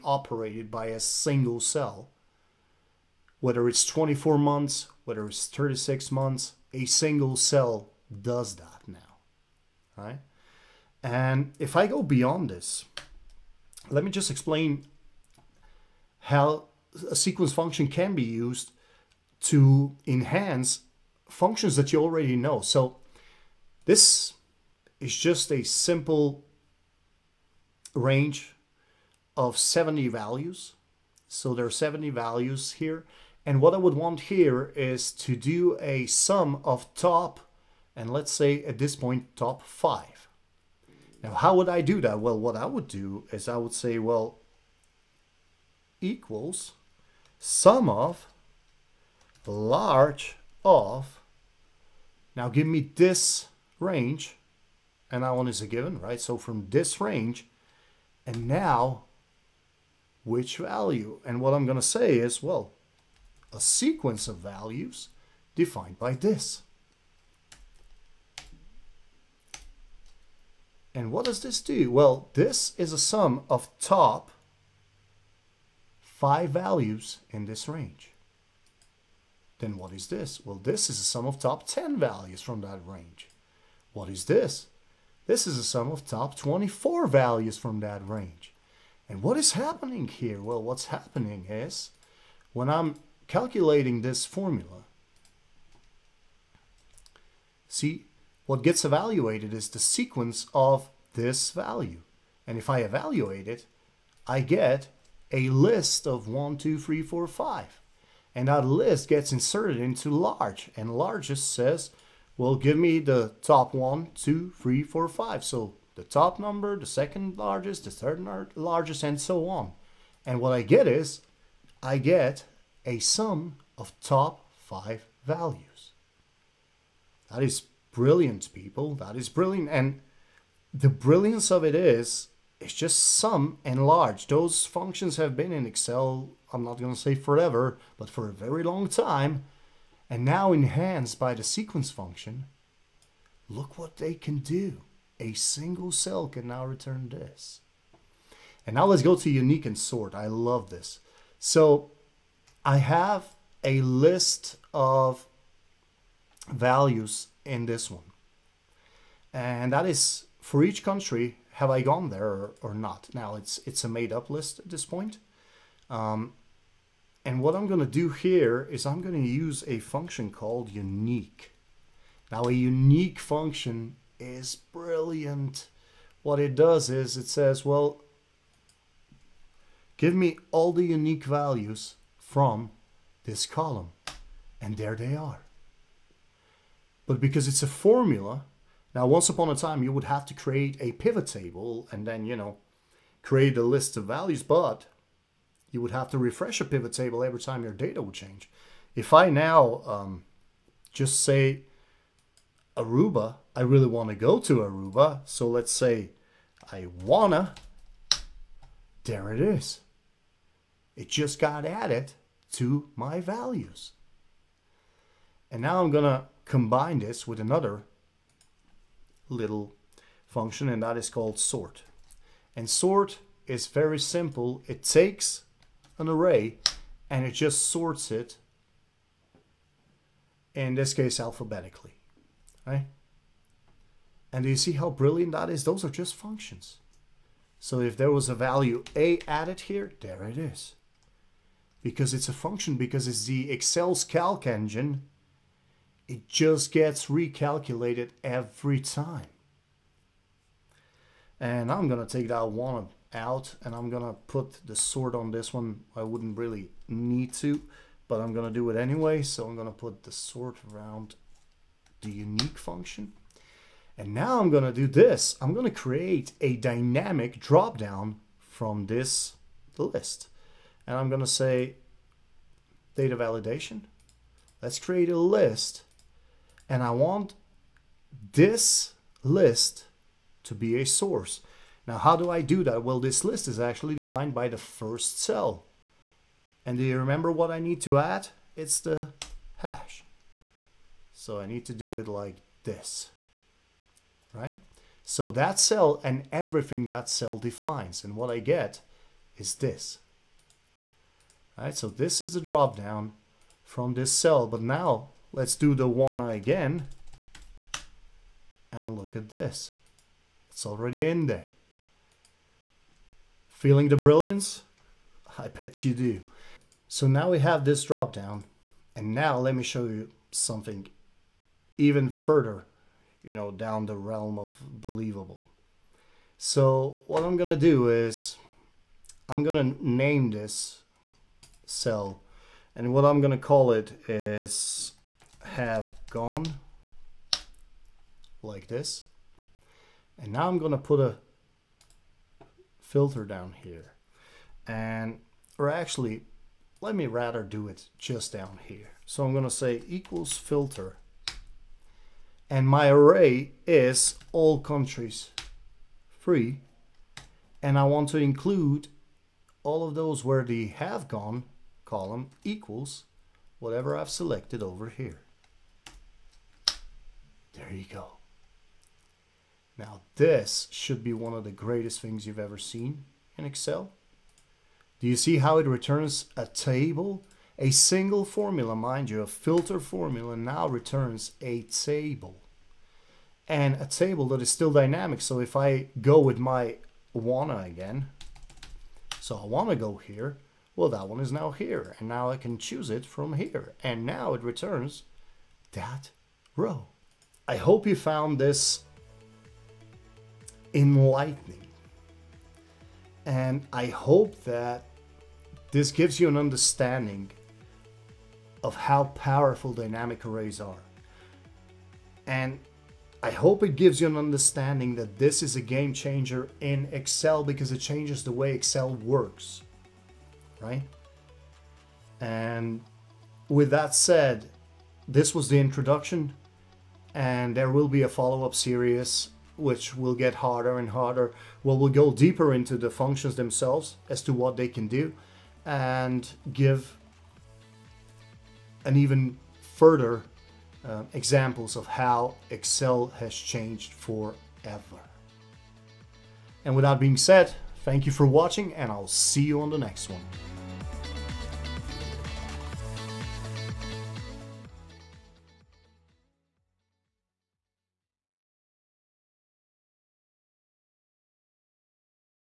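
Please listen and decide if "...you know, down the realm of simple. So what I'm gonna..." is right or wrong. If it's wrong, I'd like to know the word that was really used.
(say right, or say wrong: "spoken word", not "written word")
wrong: "believable", not "simple".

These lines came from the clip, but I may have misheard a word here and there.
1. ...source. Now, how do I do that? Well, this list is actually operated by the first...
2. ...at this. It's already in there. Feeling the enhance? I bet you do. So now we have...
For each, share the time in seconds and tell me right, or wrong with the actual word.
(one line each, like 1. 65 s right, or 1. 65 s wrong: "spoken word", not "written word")
1. 280 s wrong: "defined", not "operated"
2. 309 s wrong: "brilliance", not "enhance".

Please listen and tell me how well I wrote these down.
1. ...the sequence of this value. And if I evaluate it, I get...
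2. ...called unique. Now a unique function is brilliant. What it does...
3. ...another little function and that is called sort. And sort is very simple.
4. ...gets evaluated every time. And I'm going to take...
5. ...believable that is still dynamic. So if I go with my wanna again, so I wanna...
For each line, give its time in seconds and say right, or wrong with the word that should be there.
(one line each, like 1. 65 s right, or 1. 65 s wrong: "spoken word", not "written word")
1. 99 s right
2. 170 s right
3. 217 s right
4. 246 s wrong: "recalculated", not "evaluated"
5. 383 s wrong: "table", not "believable".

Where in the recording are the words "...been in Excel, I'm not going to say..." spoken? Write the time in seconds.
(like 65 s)
135 s.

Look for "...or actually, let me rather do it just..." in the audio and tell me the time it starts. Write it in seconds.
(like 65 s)
345 s.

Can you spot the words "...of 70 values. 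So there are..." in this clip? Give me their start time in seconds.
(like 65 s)
29 s.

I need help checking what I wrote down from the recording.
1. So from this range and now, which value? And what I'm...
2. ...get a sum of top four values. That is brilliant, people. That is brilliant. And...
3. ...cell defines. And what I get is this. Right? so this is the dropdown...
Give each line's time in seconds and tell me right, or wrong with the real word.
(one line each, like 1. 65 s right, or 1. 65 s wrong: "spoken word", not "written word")
1. 56 s right
2. 121 s wrong: "five", not "four"
3. 297 s right.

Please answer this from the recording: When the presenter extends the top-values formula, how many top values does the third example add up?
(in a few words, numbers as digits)
24.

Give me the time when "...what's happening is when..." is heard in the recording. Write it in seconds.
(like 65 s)
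90 s.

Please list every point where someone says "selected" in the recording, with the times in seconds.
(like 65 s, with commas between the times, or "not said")
364 s.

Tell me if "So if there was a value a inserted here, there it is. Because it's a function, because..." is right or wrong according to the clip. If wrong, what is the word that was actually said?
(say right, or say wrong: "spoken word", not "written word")
wrong: "added", not "inserted".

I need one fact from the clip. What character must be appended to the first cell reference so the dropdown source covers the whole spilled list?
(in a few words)
hash.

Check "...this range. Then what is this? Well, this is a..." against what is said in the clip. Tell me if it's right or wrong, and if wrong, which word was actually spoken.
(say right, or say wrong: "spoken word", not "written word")
right.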